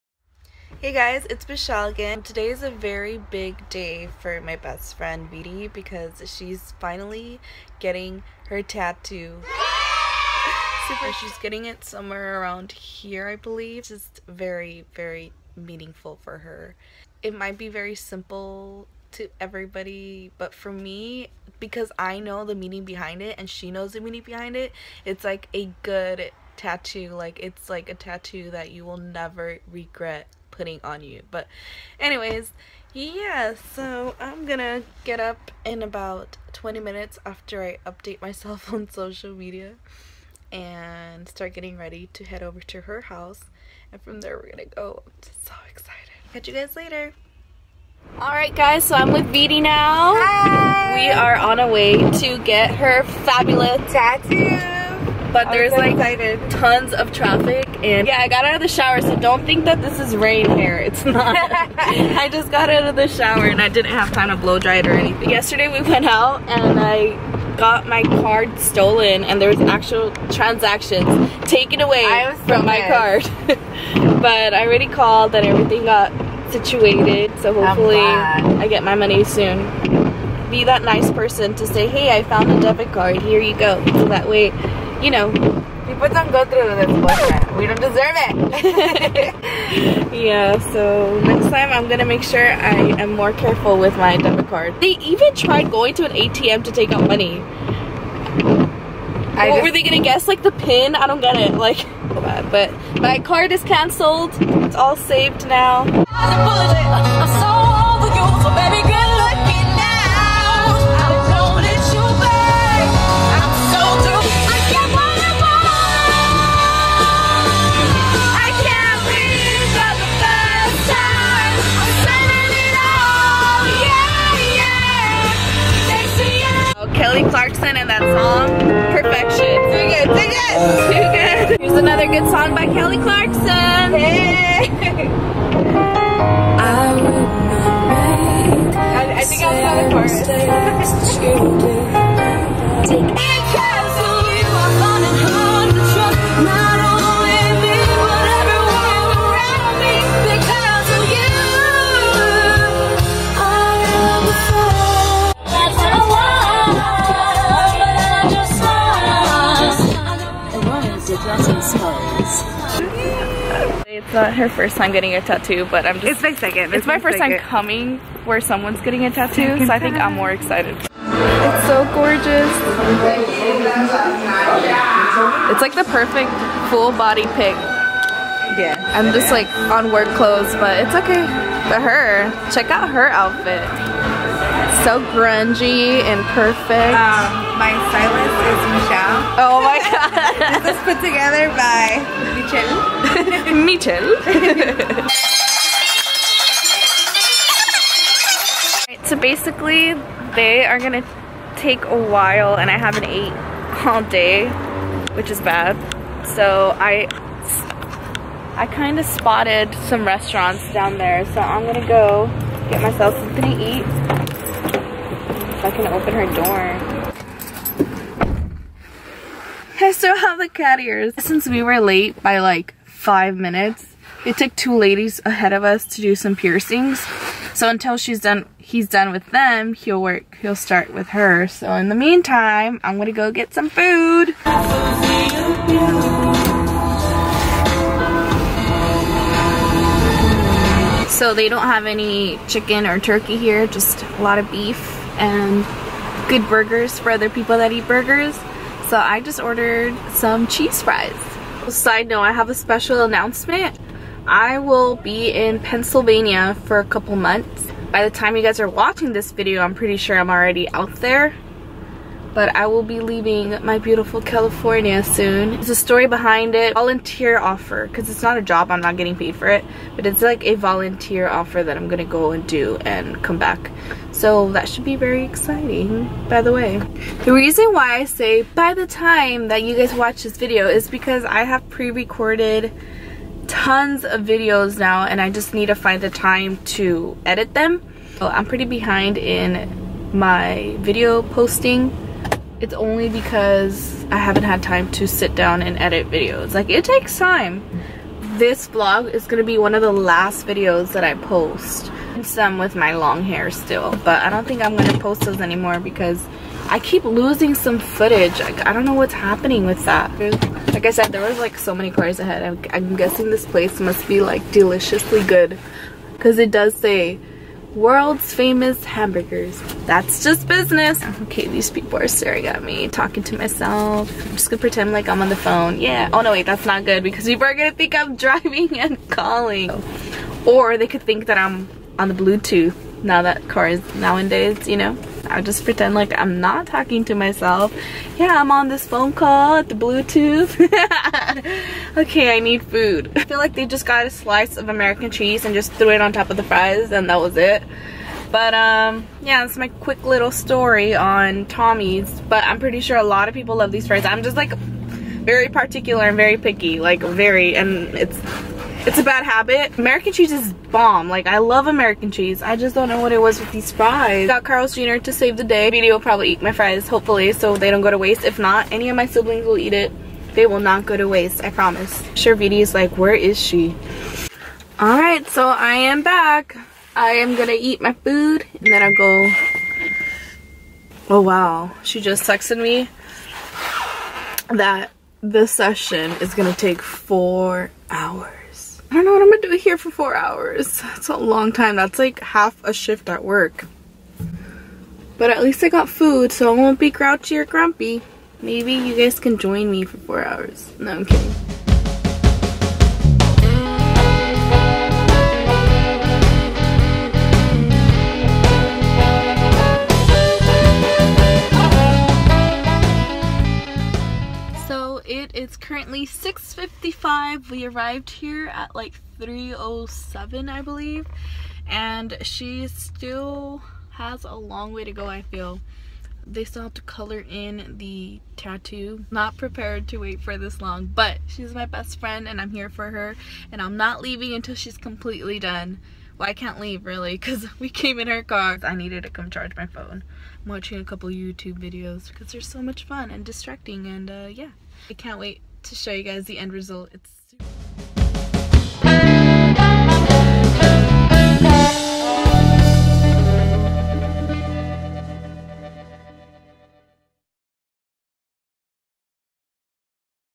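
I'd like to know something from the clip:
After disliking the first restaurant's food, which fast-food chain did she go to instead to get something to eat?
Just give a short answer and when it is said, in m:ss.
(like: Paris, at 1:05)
Carl's Jr., at 6:04.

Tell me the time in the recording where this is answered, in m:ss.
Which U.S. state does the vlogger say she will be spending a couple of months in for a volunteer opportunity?
4:15.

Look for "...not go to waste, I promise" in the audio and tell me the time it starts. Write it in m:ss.
6:10.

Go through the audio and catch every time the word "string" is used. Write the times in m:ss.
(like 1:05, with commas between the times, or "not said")
not said.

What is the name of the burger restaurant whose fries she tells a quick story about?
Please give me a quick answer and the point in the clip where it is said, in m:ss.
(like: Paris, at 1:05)
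Tommy's, at 5:51.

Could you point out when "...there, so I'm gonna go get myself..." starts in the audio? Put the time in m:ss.
3:30.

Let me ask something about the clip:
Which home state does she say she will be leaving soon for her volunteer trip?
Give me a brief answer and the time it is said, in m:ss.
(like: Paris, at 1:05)
California, at 4:24.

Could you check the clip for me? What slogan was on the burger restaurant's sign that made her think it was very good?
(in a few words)
World's famous hamburgers.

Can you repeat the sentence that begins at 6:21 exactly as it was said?
Oh wow, she just texted me that this session is gonna take four hours.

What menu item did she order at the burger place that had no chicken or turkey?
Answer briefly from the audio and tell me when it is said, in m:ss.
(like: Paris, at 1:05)
Cheese fries, at 4:10.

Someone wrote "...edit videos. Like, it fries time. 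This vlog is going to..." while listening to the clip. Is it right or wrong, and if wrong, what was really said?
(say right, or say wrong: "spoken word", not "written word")
wrong: "takes", not "fries".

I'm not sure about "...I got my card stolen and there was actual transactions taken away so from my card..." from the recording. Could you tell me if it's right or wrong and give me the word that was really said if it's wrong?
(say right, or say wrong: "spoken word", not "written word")
right.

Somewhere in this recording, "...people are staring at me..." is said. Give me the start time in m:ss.
5:21.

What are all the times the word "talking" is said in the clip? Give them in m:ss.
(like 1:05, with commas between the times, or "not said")
5:22, 5:36.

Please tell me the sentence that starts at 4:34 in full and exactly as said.
So that should be very exciting, by the way.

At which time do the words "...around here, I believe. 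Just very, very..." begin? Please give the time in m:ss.
0:12.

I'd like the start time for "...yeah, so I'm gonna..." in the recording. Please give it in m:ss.
0:32.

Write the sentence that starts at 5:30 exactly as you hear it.
Or they could think that I'm on the Bluetooth now that cars nowadays, you know?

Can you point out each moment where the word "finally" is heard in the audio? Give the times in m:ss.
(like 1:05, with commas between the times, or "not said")
0:06.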